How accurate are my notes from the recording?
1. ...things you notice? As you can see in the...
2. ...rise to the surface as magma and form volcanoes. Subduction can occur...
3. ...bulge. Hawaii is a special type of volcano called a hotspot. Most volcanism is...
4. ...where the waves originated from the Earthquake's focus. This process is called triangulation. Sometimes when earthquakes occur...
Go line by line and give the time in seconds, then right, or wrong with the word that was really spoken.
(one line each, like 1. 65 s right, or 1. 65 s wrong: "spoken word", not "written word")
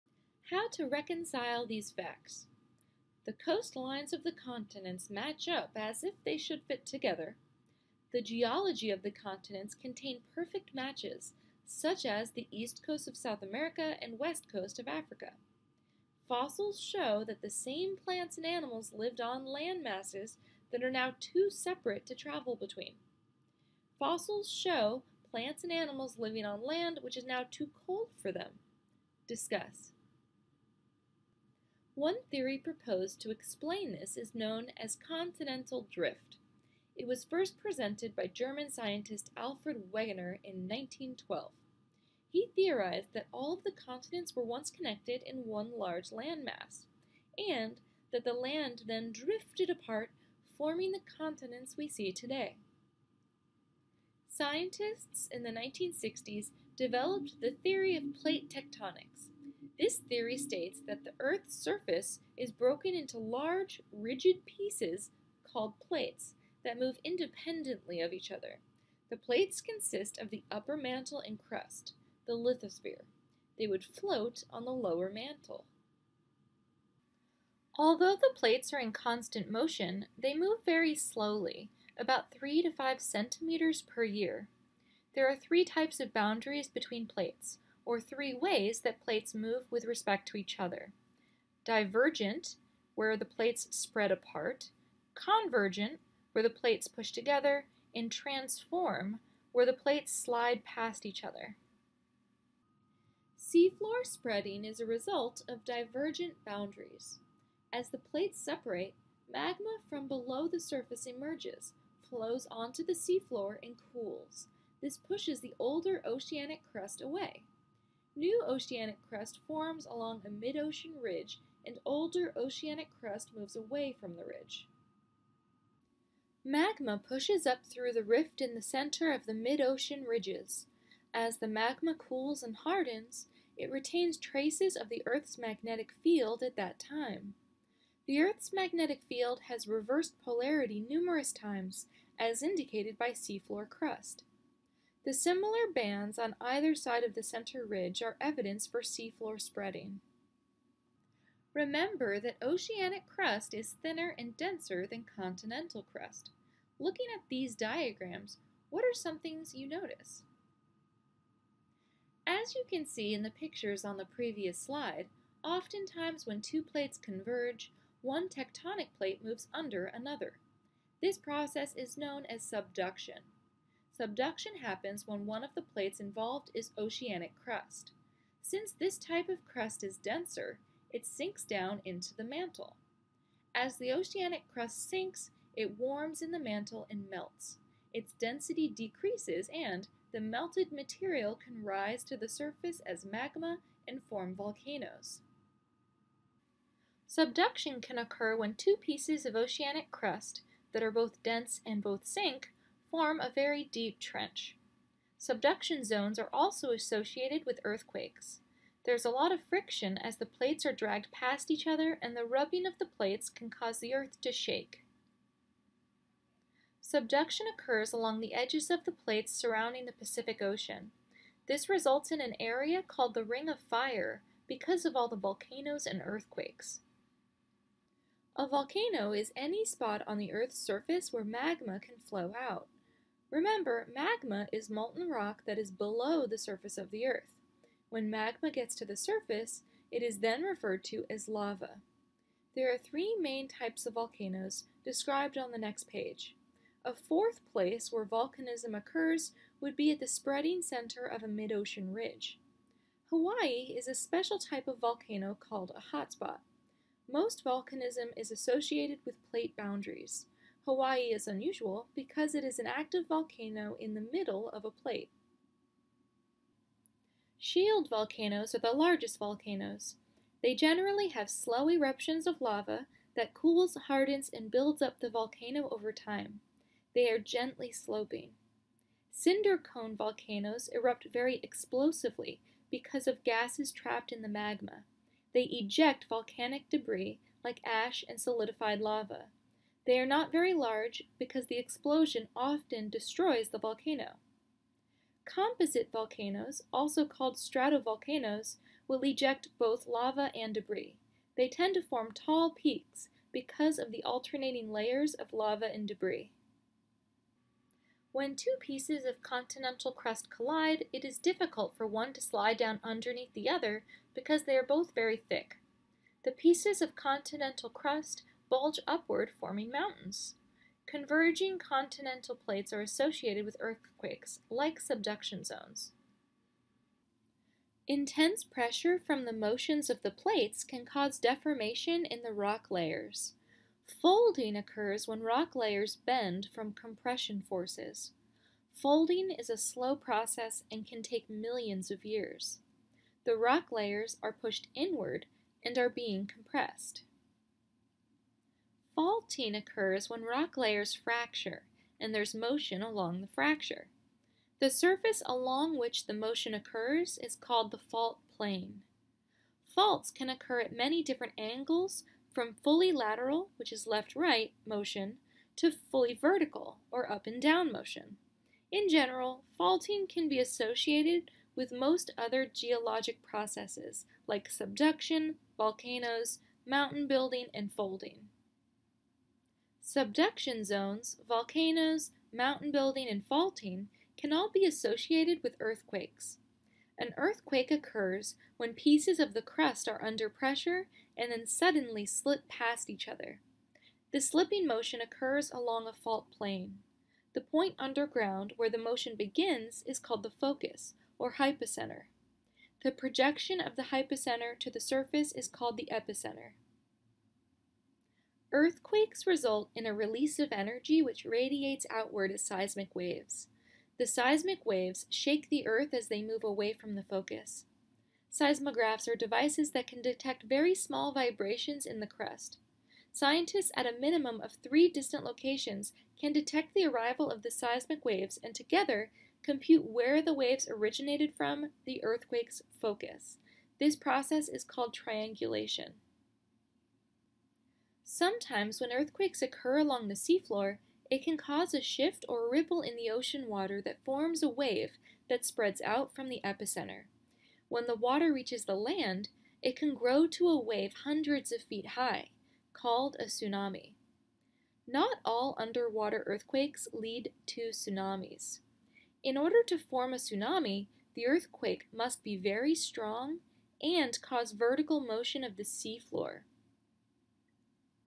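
1. 159 s right
2. 191 s right
3. 251 s wrong: "ridge", not "bulge"
4. 429 s right.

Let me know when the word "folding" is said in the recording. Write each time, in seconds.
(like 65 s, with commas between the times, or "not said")
334 s, 338 s, 377 s.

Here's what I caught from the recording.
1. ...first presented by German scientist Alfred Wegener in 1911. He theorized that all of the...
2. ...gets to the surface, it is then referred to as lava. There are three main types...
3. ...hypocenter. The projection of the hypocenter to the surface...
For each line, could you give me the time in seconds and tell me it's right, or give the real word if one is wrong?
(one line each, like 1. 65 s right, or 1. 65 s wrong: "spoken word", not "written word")
1. 37 s wrong: "1912", not "1911"
2. 238 s right
3. 401 s right.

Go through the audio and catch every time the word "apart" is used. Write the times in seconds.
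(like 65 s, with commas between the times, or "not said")
49 s, 94 s.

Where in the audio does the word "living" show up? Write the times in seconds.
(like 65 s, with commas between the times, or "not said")
26 s.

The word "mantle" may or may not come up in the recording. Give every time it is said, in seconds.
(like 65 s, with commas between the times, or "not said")
70 s, 75 s, 182 s, 186 s.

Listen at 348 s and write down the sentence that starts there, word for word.
Faulting occurs when rock layers fracture and there's motion along the fracture.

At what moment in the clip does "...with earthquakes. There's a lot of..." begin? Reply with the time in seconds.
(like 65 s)
207 s.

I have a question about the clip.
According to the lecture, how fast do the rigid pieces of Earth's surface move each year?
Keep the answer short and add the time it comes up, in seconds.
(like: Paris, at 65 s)
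3 to 5 centimeters, at 82 s.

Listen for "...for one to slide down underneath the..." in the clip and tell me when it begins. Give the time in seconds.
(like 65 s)
311 s.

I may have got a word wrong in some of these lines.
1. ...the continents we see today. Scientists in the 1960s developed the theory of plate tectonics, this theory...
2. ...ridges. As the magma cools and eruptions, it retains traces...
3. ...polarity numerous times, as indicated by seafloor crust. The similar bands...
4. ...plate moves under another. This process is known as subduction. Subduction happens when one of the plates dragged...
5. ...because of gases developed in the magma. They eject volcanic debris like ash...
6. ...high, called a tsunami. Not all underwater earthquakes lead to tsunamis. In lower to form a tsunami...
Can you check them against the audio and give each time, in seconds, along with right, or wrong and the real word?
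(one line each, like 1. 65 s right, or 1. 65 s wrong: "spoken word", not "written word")
1. 50 s right
2. 130 s wrong: "hardens", not "eruptions"
3. 140 s right
4. 168 s wrong: "involved", not "dragged"
5. 282 s wrong: "trapped", not "developed"
6. 451 s wrong: "order", not "lower".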